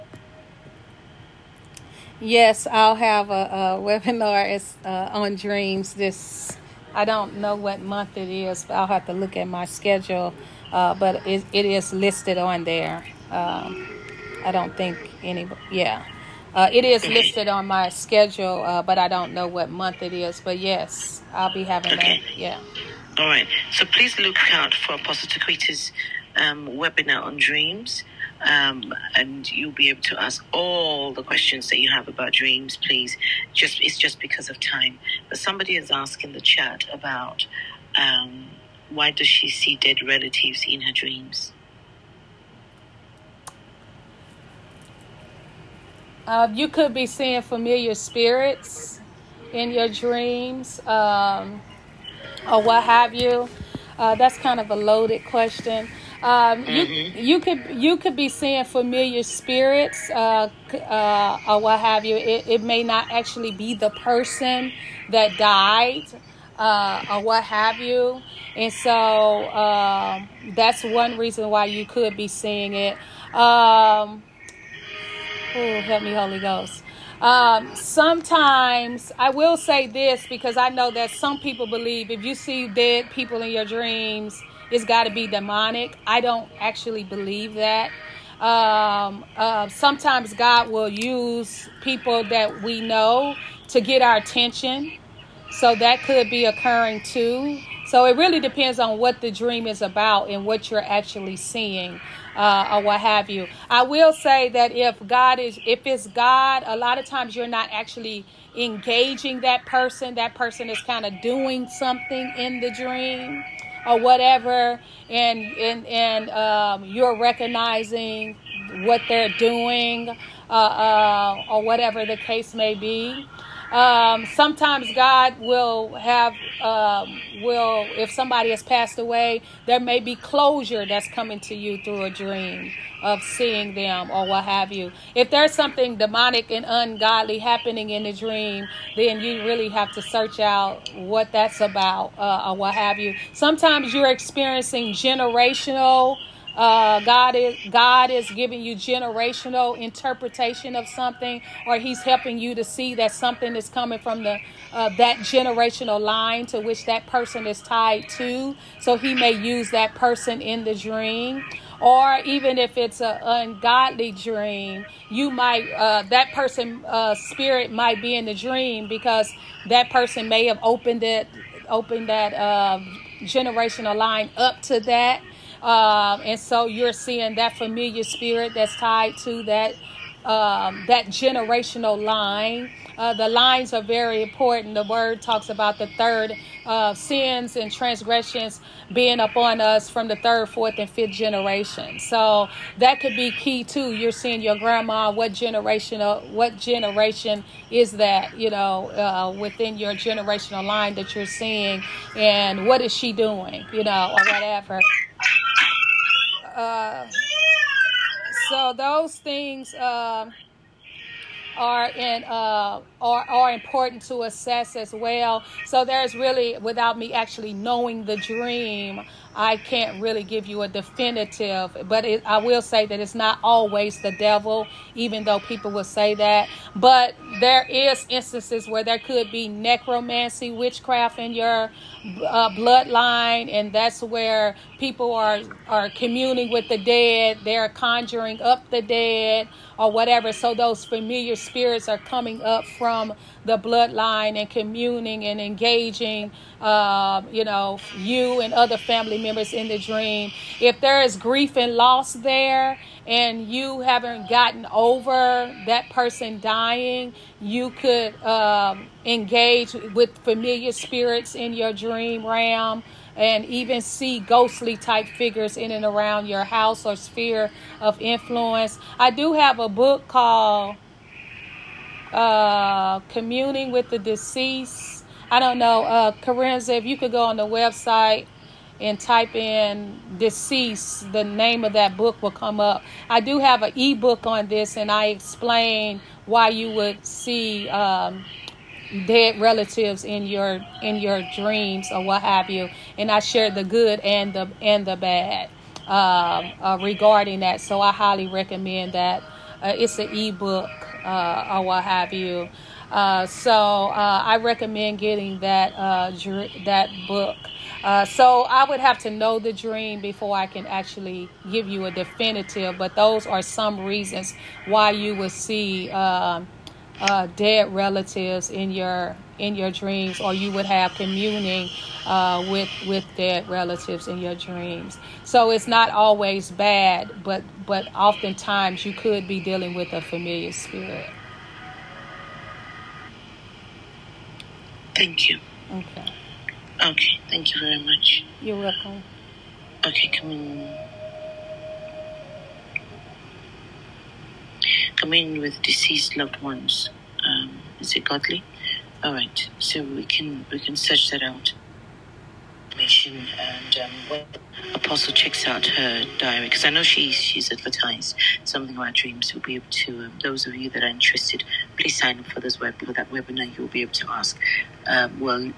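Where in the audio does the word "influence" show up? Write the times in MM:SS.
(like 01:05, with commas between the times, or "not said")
04:27.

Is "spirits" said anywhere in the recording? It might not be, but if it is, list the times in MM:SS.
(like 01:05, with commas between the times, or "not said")
00:47, 00:59, 02:47, 02:58, 04:01, 04:20, 05:30.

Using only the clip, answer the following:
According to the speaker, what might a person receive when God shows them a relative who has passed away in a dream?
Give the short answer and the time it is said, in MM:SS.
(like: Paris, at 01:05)
Closure, at 02:10.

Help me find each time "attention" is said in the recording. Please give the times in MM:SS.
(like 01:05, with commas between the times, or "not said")
01:34.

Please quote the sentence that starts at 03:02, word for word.
Uh, the lines are very important.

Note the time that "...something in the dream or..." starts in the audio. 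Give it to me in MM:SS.
01:51.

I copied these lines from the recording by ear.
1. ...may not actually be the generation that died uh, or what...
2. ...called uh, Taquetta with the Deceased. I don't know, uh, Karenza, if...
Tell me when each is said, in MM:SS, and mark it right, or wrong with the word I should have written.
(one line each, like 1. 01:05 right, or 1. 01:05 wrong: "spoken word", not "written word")
1. 01:02 wrong: "person", not "generation"
2. 04:30 wrong: "Communing", not "Taquetta".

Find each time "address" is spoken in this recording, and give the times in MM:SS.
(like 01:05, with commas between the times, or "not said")
not said.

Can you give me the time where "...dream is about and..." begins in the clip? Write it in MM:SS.
01:39.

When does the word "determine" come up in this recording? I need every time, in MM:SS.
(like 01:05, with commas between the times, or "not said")
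not said.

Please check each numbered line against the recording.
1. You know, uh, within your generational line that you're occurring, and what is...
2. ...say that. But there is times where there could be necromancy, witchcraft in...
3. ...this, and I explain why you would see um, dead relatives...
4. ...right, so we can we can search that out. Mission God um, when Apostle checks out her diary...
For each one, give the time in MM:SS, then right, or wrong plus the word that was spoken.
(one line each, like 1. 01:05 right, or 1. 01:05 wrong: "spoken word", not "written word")
1. 03:18 wrong: "seeing", not "occurring"
2. 03:45 wrong: "instances", not "times"
3. 04:44 right
4. 05:49 wrong: "And", not "God".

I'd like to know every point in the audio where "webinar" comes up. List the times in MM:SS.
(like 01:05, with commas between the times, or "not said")
00:03, 00:26, 06:03.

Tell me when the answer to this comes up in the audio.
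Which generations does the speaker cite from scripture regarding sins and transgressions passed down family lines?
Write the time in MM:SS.
03:10.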